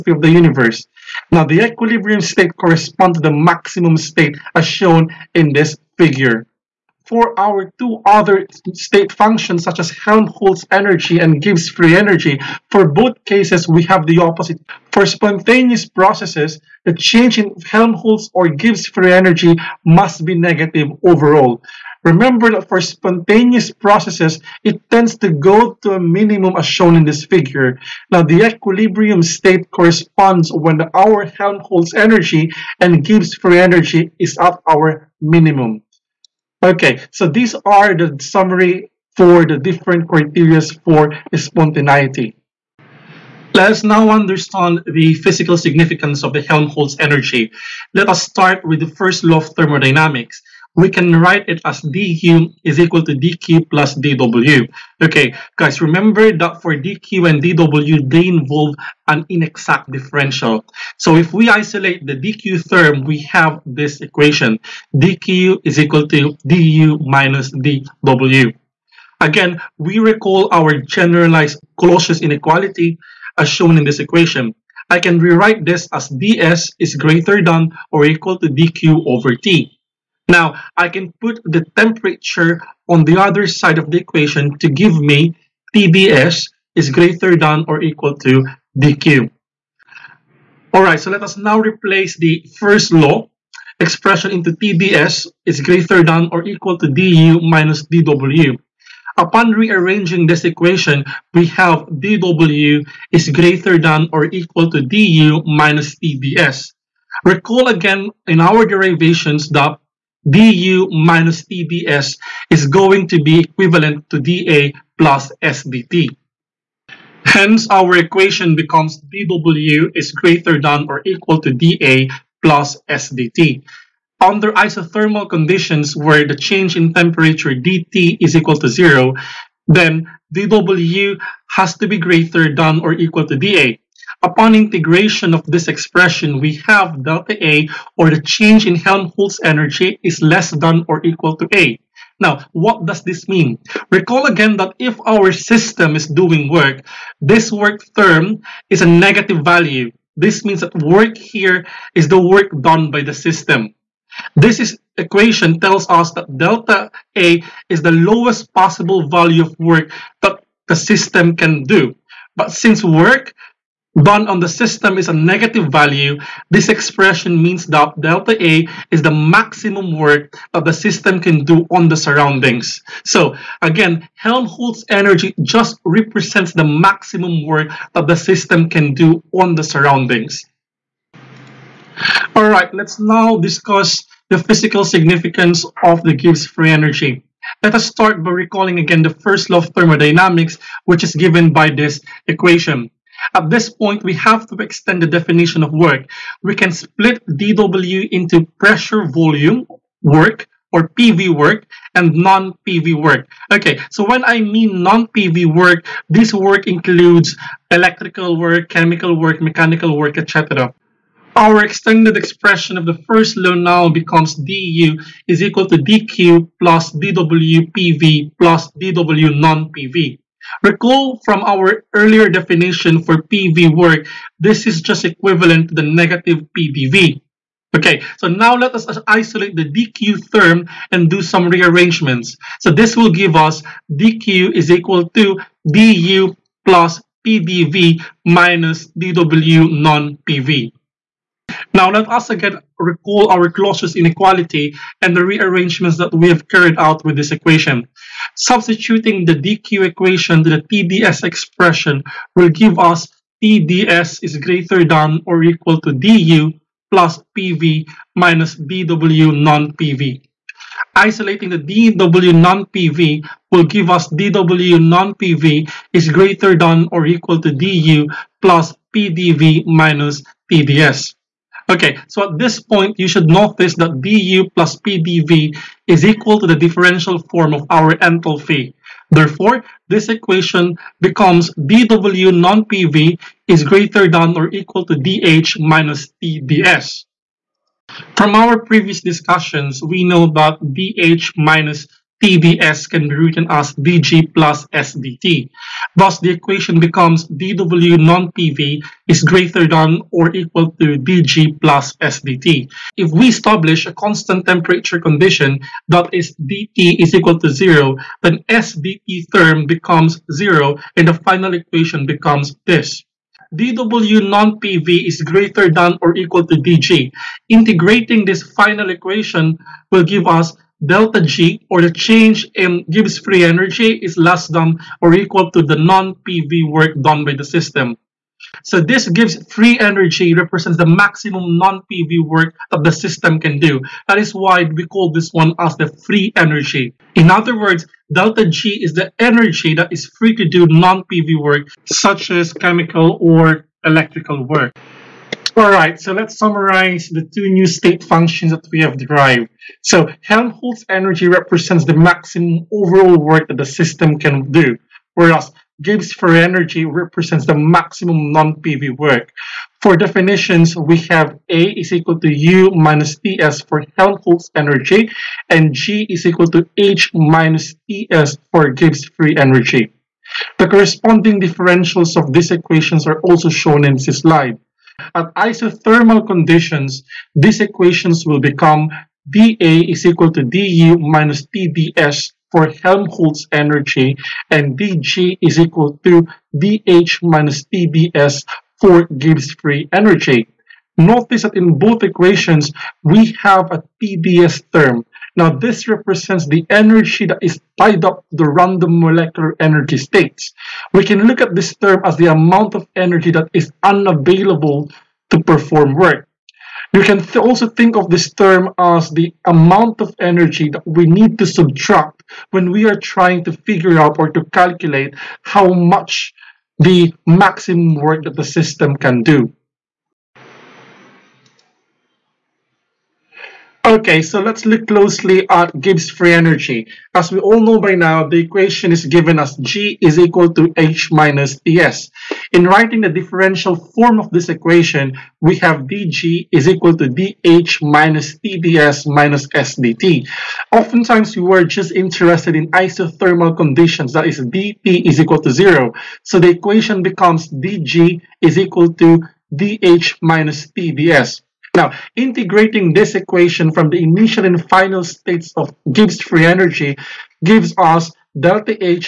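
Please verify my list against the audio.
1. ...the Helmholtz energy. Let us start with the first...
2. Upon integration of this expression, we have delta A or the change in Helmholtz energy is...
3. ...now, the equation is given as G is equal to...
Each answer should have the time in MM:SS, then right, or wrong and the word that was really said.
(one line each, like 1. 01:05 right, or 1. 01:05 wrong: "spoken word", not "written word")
1. 00:46 right
2. 02:14 right
3. 07:07 right.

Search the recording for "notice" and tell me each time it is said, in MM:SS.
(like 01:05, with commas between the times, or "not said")
04:33, 06:30.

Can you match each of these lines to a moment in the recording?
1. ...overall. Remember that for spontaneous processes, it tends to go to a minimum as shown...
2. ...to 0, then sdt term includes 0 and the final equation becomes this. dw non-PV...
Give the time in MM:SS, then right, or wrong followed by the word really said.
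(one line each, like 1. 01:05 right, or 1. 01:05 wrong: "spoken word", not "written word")
1. 00:21 right
2. 05:07 wrong: "becomes", not "includes".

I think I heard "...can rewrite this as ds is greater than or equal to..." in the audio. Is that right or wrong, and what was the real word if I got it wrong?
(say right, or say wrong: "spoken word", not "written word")
right.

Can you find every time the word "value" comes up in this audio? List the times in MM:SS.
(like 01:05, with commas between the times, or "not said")
02:29, 02:39, 02:45.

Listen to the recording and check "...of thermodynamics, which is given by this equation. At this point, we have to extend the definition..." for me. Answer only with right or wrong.
right.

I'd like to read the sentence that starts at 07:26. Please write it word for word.
So the equation becomes dG is equal to dH minus TdS.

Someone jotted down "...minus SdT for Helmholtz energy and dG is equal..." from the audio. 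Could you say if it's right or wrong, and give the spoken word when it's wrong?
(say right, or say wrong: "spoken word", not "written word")
wrong: "Tds", not "SdT".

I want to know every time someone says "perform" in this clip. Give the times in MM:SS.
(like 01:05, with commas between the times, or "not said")
06:45.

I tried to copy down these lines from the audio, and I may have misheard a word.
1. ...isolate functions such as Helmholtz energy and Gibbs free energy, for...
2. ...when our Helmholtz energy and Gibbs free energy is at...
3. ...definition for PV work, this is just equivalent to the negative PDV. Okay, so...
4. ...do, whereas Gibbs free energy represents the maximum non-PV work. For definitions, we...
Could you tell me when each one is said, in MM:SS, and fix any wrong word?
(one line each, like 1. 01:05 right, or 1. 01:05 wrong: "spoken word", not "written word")
1. 00:08 wrong: "state", not "isolate"
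2. 00:30 right
3. 03:42 right
4. 05:54 right.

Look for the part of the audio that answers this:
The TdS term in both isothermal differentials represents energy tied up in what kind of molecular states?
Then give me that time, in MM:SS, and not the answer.
06:38.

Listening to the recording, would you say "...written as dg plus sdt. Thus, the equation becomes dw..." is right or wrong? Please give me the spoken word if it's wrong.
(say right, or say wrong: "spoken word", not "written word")
right.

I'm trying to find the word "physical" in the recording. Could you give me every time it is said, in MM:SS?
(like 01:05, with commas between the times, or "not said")
00:45, 03:04.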